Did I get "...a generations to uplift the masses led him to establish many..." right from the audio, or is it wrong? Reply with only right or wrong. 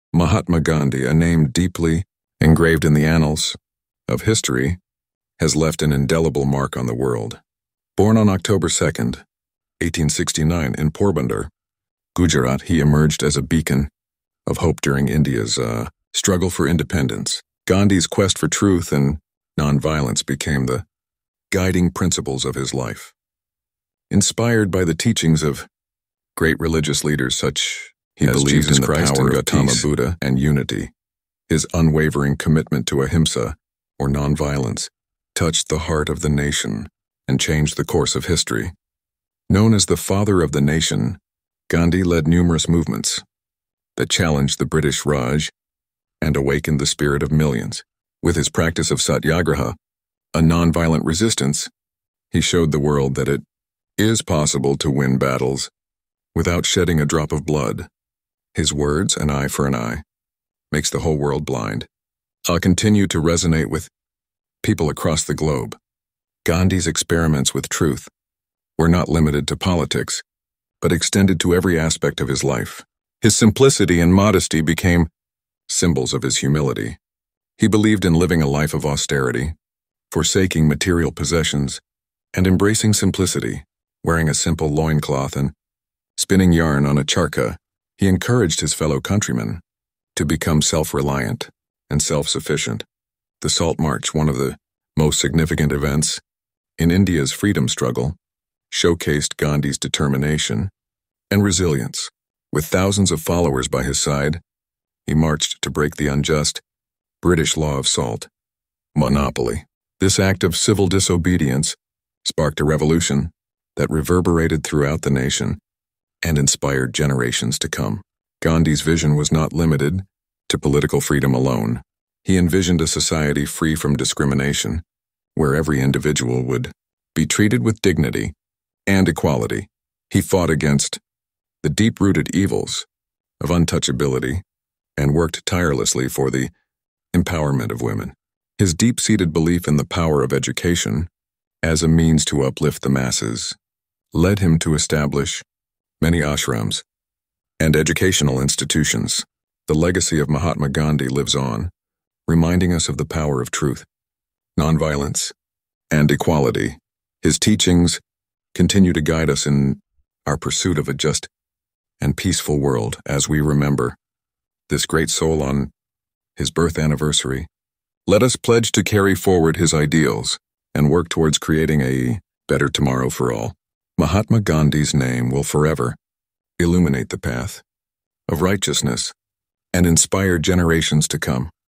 wrong.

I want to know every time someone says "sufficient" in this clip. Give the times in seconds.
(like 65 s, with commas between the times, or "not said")
92 s.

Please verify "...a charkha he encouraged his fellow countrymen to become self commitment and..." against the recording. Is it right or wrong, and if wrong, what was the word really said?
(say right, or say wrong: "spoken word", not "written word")
wrong: "reliant", not "commitment".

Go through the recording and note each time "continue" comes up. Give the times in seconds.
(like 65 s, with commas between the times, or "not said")
62 s, 158 s.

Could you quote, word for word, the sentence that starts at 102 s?
With thousands of followers by his side, he marched to break the unjust British law of salt monopoly.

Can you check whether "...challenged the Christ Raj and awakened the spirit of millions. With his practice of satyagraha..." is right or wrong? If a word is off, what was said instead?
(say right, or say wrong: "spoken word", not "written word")
wrong: "British", not "Christ".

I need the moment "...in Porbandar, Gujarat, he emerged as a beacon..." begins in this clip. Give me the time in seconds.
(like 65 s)
10 s.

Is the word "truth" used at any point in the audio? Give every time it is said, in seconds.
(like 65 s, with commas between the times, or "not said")
18 s, 67 s, 153 s.